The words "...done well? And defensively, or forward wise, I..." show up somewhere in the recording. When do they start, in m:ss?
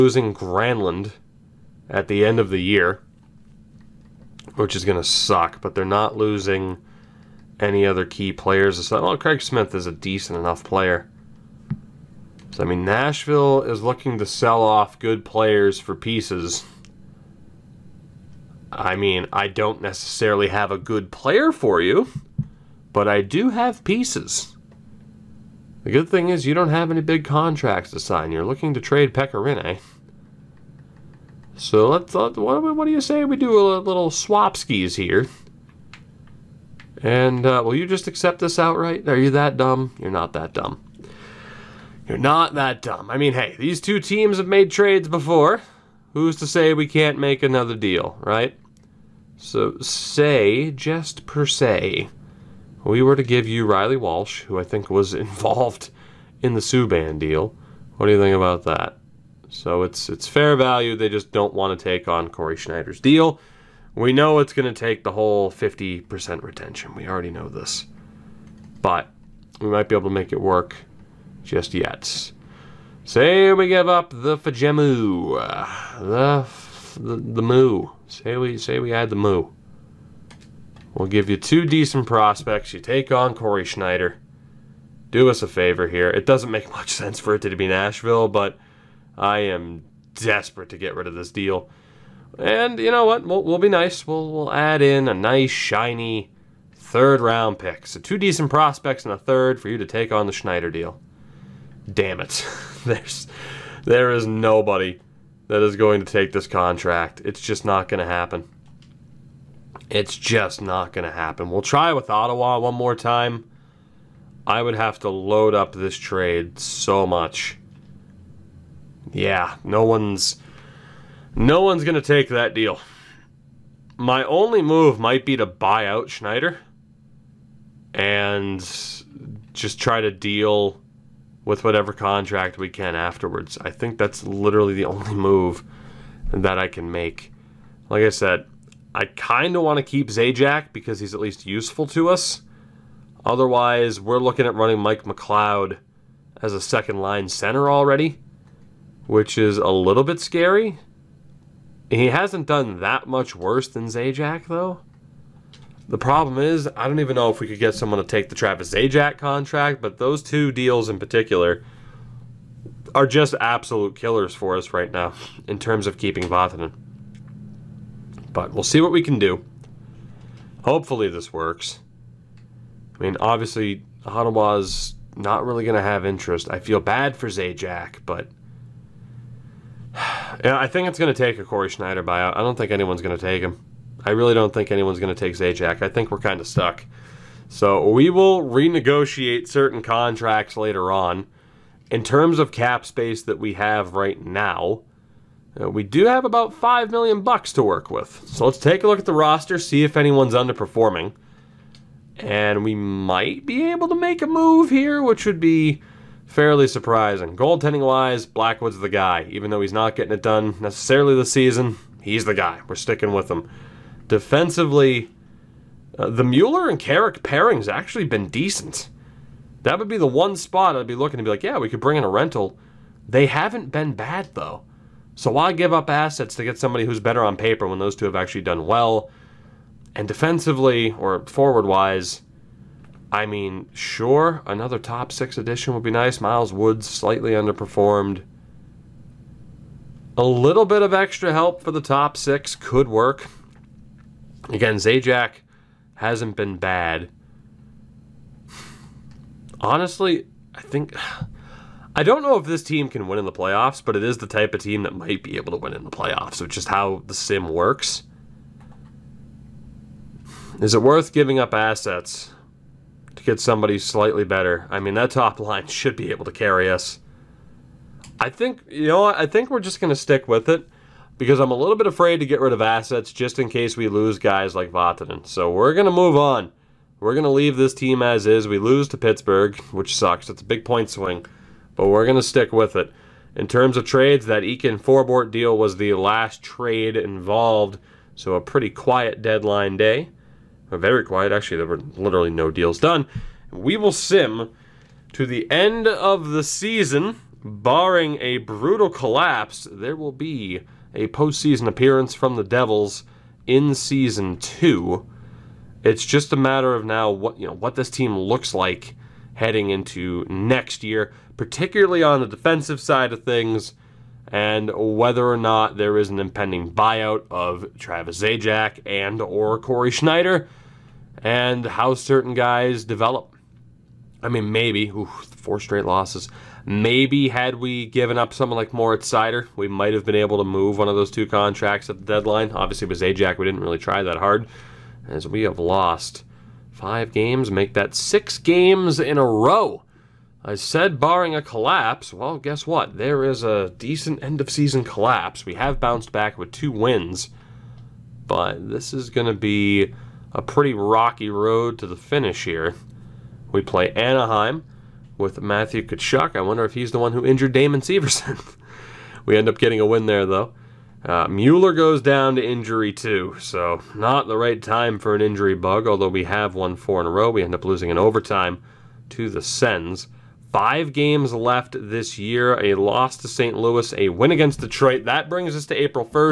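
3:48.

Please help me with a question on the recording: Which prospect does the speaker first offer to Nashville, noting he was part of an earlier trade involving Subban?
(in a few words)
Reilly Walsh.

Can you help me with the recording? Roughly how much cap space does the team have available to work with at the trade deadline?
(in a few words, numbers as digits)
5 million.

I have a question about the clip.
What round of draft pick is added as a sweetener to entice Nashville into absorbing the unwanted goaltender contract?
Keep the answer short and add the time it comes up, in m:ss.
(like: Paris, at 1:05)
third round, at 1:36.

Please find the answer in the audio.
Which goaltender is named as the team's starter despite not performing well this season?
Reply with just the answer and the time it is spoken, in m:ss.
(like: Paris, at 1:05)
Blackwood, at 3:28.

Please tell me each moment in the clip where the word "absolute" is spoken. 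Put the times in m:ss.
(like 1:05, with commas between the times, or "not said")
2:43.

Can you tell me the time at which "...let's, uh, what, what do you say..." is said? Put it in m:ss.
0:31.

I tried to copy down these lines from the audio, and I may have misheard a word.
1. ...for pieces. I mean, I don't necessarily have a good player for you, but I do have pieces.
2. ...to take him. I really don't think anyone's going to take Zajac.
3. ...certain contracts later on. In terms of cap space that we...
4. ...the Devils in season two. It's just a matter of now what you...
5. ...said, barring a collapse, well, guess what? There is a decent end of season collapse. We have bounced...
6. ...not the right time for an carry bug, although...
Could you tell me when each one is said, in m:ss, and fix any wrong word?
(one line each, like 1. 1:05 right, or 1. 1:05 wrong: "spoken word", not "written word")
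1. 0:15 right
2. 3:03 right
3. 3:09 right
4. 5:02 right
5. 5:40 right
6. 6:03 wrong: "injury", not "carry".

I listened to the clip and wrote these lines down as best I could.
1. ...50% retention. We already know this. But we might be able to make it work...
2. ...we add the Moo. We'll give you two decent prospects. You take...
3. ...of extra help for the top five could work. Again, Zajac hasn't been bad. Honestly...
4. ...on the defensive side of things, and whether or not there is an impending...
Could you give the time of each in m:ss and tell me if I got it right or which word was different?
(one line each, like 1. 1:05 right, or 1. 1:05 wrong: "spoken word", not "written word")
1. 1:05 right
2. 1:18 right
3. 4:00 wrong: "six", not "five"
4. 5:12 right.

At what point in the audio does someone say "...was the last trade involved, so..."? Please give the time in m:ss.
4:45.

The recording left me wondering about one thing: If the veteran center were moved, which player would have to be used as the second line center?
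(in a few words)
Mike McLeod.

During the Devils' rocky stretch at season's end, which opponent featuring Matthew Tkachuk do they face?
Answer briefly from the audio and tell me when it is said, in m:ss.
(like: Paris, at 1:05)
Anaheim, at 5:53.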